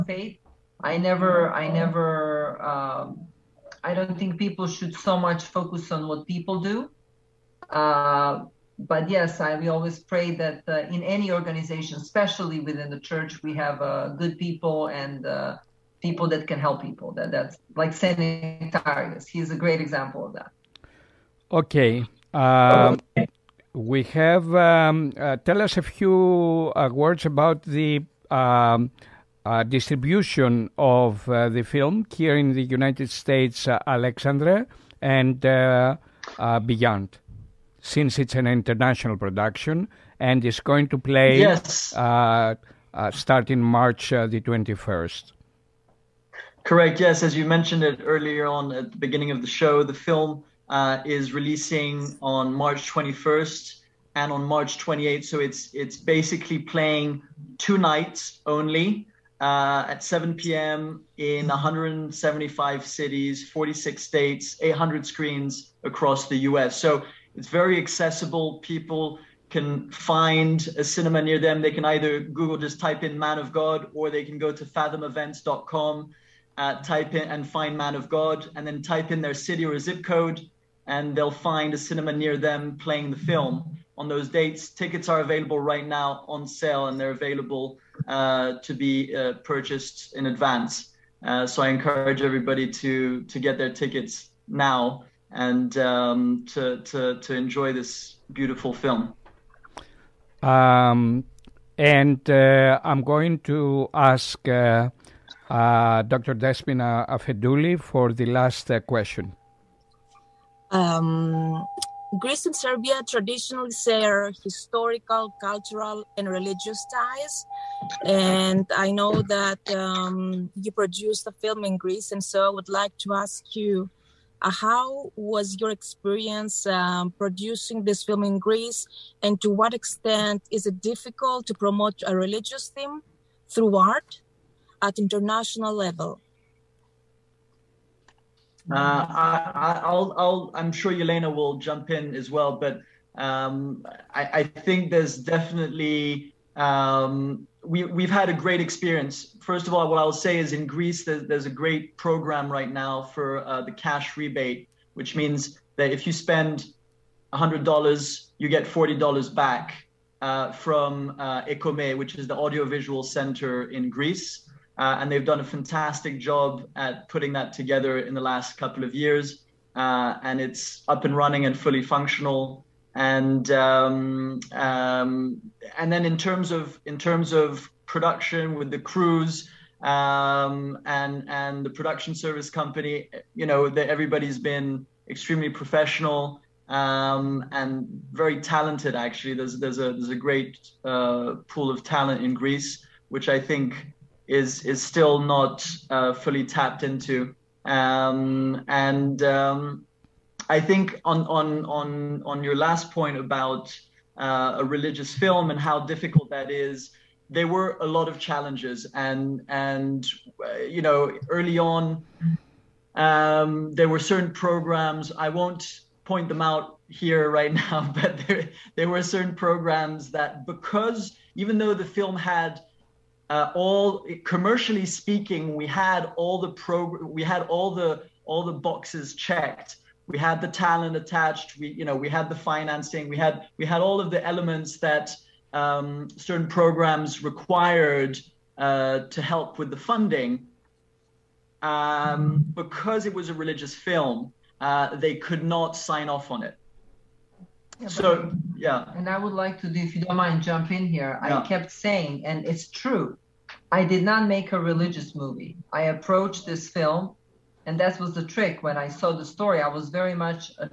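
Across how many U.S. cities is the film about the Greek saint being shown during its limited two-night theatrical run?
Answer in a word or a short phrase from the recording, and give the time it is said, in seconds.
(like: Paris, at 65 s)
175, at 61 s.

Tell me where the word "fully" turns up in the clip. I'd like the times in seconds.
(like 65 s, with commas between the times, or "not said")
171 s, 196 s.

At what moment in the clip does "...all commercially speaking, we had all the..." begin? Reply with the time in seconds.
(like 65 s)
223 s.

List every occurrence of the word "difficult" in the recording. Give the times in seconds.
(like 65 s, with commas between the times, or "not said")
130 s, 205 s.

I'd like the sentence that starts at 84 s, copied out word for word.
Tickets are available right now on sale and they're available uh, to be uh, purchased in advance.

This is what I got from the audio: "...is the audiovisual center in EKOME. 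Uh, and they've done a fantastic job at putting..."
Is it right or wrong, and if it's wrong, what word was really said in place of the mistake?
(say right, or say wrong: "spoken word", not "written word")
wrong: "Greece", not "EKOME".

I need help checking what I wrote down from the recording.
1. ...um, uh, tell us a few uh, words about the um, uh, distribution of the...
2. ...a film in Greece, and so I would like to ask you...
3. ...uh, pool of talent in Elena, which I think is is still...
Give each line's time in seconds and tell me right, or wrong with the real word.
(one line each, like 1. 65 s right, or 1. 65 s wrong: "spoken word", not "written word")
1. 24 s right
2. 121 s right
3. 190 s wrong: "Greece", not "Elena".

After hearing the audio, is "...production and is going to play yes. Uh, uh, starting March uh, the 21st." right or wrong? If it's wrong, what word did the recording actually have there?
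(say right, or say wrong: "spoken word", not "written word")
right.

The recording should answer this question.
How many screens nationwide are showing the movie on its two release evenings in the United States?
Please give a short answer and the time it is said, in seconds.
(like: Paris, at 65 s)
800, at 64 s.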